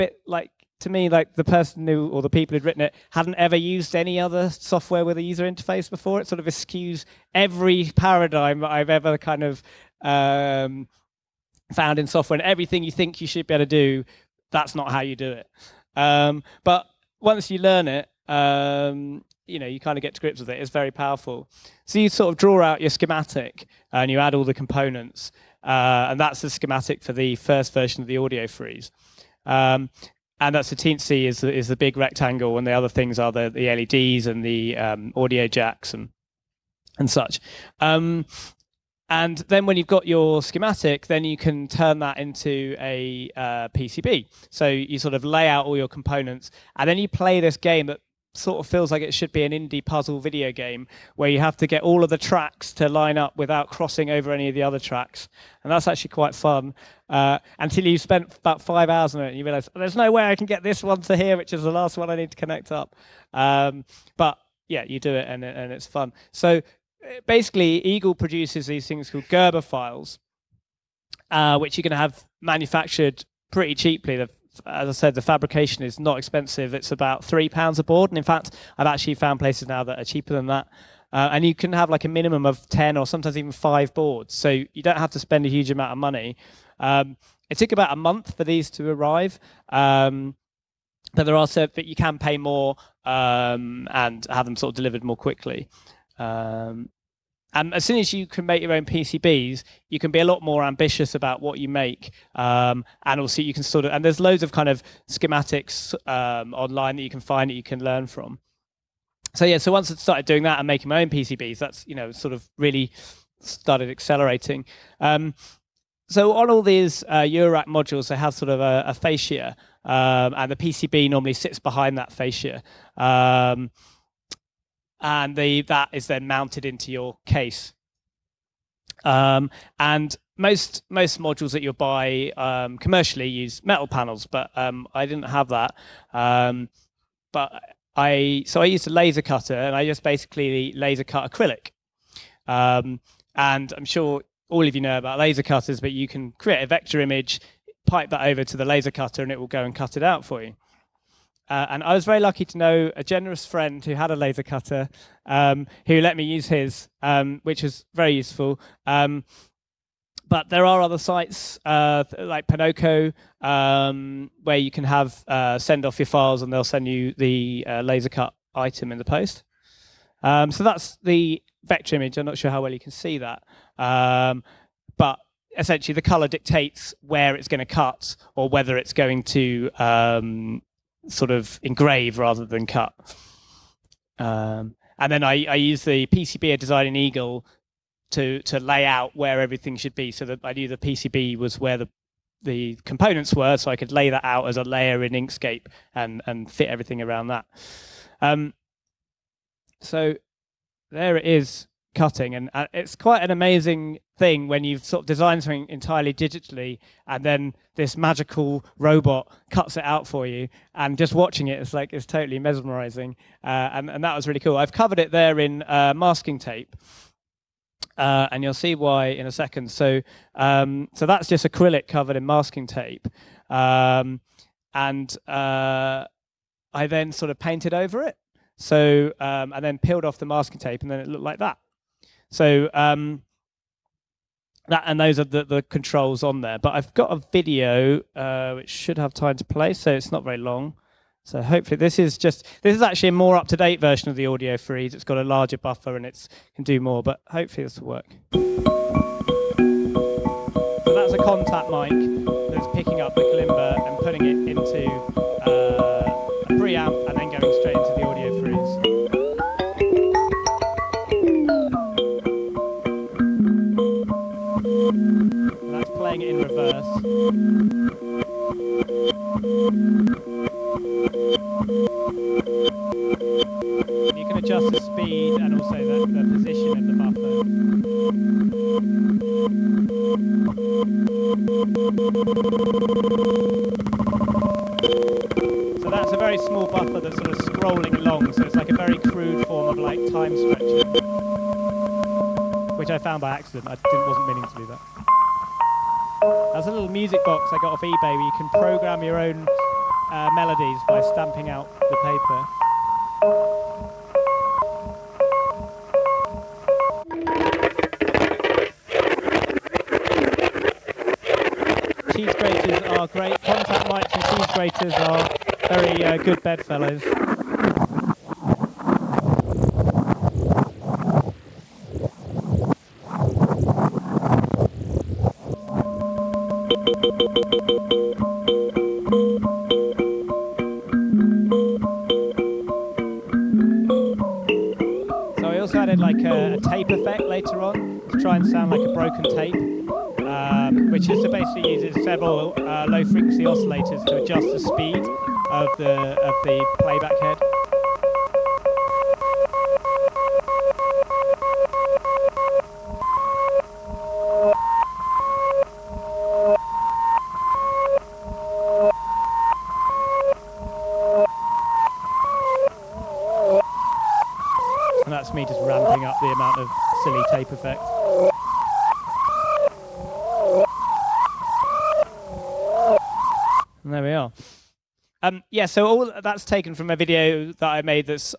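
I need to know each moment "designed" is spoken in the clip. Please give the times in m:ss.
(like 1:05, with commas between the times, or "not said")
3:06, 3:25.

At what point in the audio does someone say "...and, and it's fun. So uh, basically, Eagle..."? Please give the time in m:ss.
1:05.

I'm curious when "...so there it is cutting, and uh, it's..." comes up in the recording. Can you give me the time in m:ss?
3:19.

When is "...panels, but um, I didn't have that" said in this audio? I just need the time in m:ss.
2:13.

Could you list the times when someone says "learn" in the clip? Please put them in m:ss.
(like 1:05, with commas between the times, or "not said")
0:17, 1:47.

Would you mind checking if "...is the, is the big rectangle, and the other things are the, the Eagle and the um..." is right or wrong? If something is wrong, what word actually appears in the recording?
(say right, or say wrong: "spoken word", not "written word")
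wrong: "LEDs", not "Eagle".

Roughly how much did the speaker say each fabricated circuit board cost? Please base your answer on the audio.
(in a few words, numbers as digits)
£3.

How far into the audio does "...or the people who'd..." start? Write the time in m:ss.
0:02.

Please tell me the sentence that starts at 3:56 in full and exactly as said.
But I've got a video uh, which should have time to play, so it's not very long.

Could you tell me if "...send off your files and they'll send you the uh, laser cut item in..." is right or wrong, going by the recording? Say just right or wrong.
right.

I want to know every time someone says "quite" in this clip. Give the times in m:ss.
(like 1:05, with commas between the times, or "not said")
0:56, 3:22.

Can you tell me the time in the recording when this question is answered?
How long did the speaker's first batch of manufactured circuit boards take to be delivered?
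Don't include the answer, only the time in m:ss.
1:27.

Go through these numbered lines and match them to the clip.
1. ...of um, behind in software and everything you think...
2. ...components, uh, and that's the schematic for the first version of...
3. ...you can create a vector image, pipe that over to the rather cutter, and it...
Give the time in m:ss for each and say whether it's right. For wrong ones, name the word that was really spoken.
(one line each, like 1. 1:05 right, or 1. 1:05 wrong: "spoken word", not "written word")
1. 0:09 wrong: "found", not "behind"
2. 0:24 right
3. 2:25 wrong: "laser", not "rather".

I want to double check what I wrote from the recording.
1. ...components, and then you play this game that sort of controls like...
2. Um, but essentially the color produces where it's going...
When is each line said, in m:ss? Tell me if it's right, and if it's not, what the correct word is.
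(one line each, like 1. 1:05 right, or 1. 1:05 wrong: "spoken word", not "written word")
1. 0:45 wrong: "feels", not "controls"
2. 2:53 wrong: "dictates", not "produces".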